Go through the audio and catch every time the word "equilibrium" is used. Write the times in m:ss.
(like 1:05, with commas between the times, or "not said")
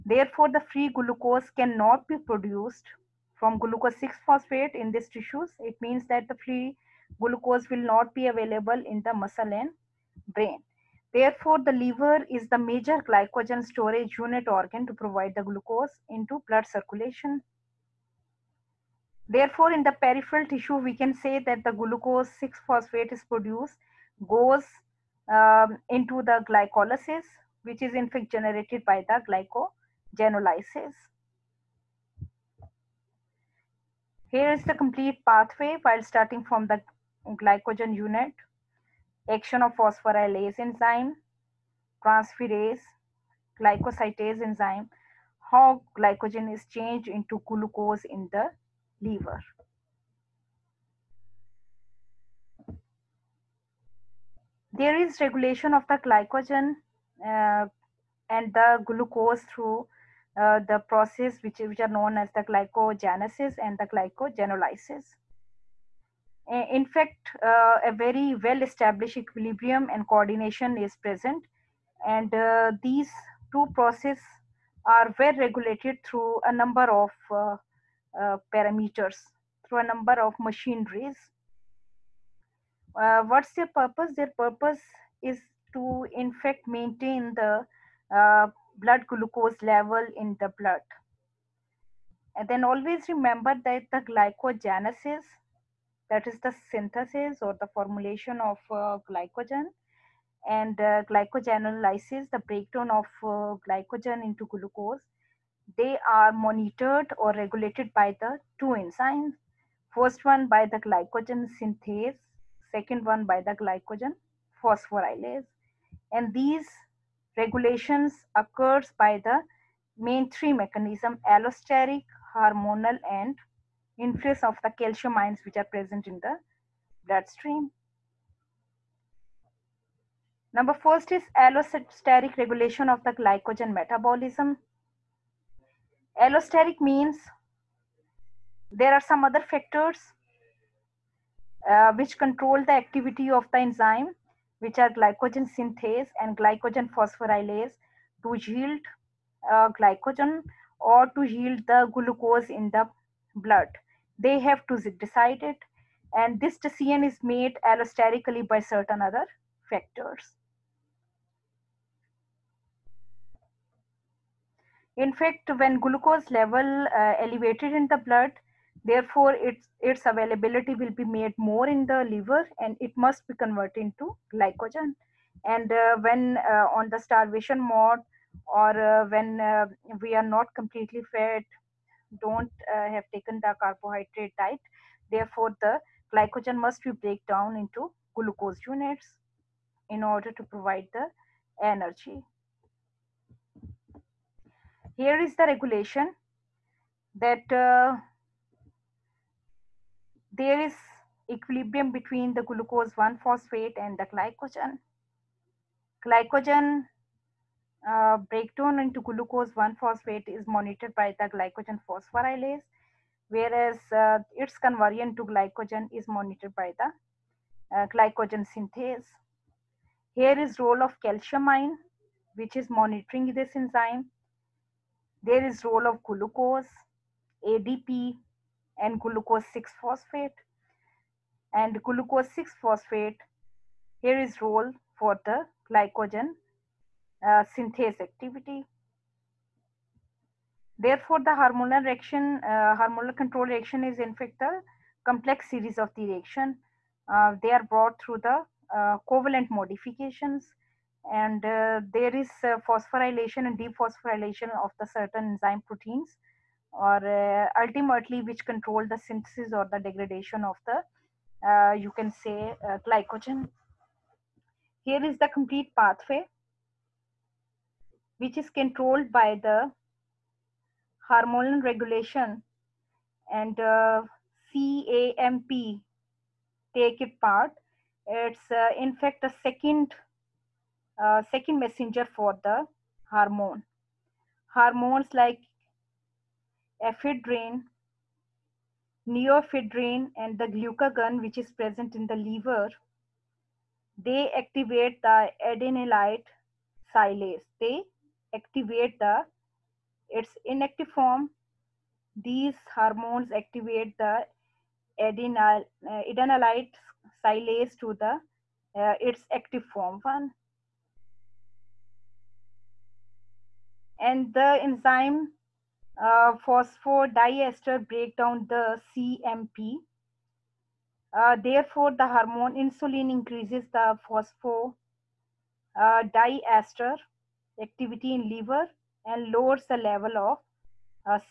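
1:09, 3:21.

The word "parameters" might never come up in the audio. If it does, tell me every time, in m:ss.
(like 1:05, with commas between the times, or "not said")
1:18.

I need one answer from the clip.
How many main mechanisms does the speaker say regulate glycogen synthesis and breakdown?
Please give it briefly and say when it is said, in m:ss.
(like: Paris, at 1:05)
3, at 2:00.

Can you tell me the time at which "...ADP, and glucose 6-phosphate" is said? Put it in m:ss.
3:47.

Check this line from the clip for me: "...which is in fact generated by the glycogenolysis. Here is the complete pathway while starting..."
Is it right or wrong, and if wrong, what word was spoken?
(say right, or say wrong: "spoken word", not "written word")
right.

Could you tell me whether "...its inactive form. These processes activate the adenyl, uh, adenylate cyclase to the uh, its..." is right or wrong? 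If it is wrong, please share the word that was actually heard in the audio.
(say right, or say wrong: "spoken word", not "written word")
wrong: "hormones", not "processes".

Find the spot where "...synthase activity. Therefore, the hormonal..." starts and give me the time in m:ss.
3:57.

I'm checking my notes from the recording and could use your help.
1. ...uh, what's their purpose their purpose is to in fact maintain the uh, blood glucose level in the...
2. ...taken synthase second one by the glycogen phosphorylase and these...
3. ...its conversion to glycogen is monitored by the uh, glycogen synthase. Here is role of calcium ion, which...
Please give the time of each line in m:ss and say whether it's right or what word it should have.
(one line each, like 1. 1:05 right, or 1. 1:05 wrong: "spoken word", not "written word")
1. 1:23 right
2. 1:50 wrong: "glycogen", not "taken"
3. 3:34 right.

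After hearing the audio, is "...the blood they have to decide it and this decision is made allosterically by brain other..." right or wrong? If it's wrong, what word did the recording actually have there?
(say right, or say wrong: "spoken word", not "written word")
wrong: "certain", not "brain".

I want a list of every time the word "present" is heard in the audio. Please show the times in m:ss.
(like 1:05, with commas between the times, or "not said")
1:11, 2:05, 4:51.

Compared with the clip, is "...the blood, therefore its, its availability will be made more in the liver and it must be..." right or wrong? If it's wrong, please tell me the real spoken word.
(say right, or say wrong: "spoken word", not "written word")
right.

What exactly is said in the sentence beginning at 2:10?
Number first is allosteric regulation of the glycogen metabolism.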